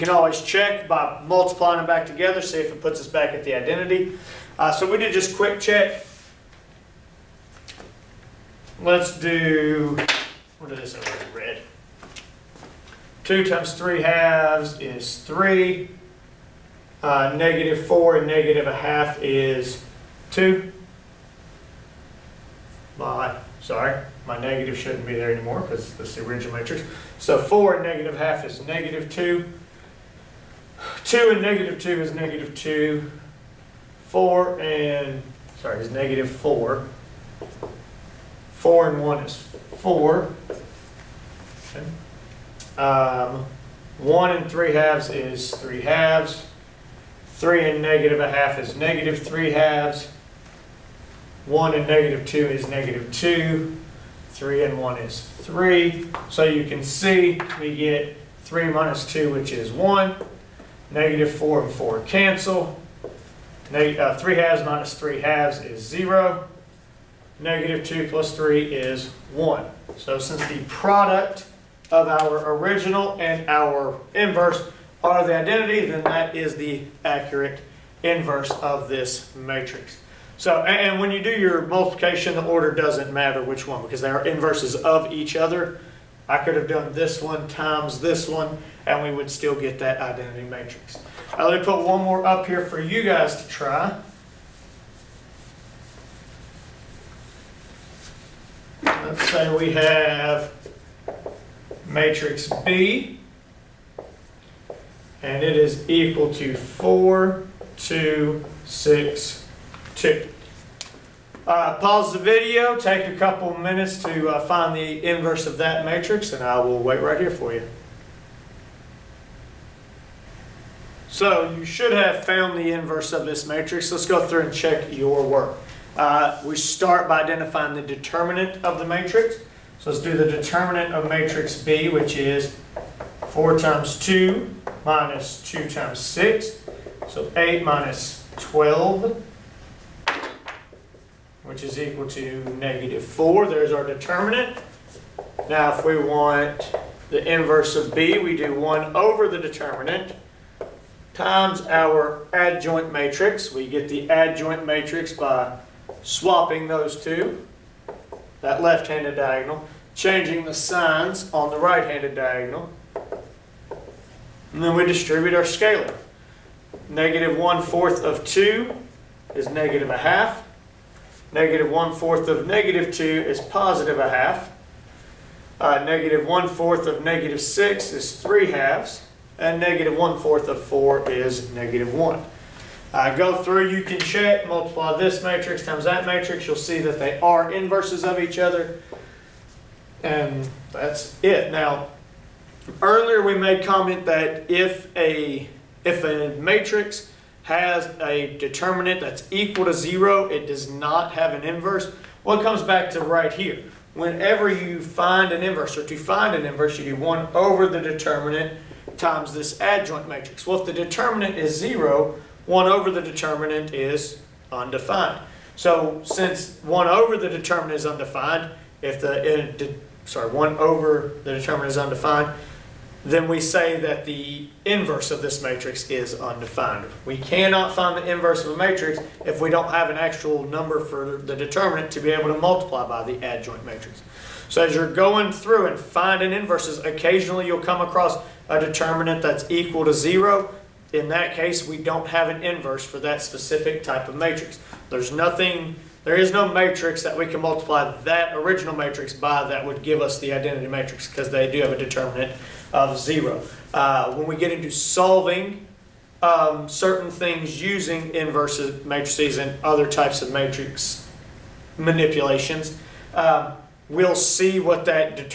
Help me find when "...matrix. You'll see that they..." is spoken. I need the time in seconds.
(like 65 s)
186 s.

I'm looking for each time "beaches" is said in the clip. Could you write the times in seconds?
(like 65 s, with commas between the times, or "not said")
not said.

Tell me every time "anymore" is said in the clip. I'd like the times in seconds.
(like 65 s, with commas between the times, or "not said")
25 s.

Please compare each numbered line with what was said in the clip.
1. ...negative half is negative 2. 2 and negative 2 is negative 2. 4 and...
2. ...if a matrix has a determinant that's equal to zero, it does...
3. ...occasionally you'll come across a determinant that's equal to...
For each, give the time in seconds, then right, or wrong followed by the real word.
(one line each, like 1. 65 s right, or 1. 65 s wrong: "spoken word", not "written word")
1. 27 s right
2. 195 s right
3. 236 s right.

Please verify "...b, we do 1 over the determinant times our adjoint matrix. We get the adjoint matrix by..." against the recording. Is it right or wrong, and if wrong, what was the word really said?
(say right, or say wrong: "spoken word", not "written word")
right.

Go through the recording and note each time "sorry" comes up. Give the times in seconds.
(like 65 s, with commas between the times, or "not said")
23 s, 35 s, 220 s.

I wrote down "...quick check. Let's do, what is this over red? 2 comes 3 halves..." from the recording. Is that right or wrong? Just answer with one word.
wrong.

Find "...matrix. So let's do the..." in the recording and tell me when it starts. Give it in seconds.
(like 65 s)
128 s.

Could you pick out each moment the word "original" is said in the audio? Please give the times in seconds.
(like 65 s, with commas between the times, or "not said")
26 s, 72 s, 248 s.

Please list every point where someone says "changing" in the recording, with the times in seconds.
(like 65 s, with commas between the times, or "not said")
159 s.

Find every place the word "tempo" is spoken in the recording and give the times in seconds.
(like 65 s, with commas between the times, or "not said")
not said.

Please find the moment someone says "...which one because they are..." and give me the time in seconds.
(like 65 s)
83 s.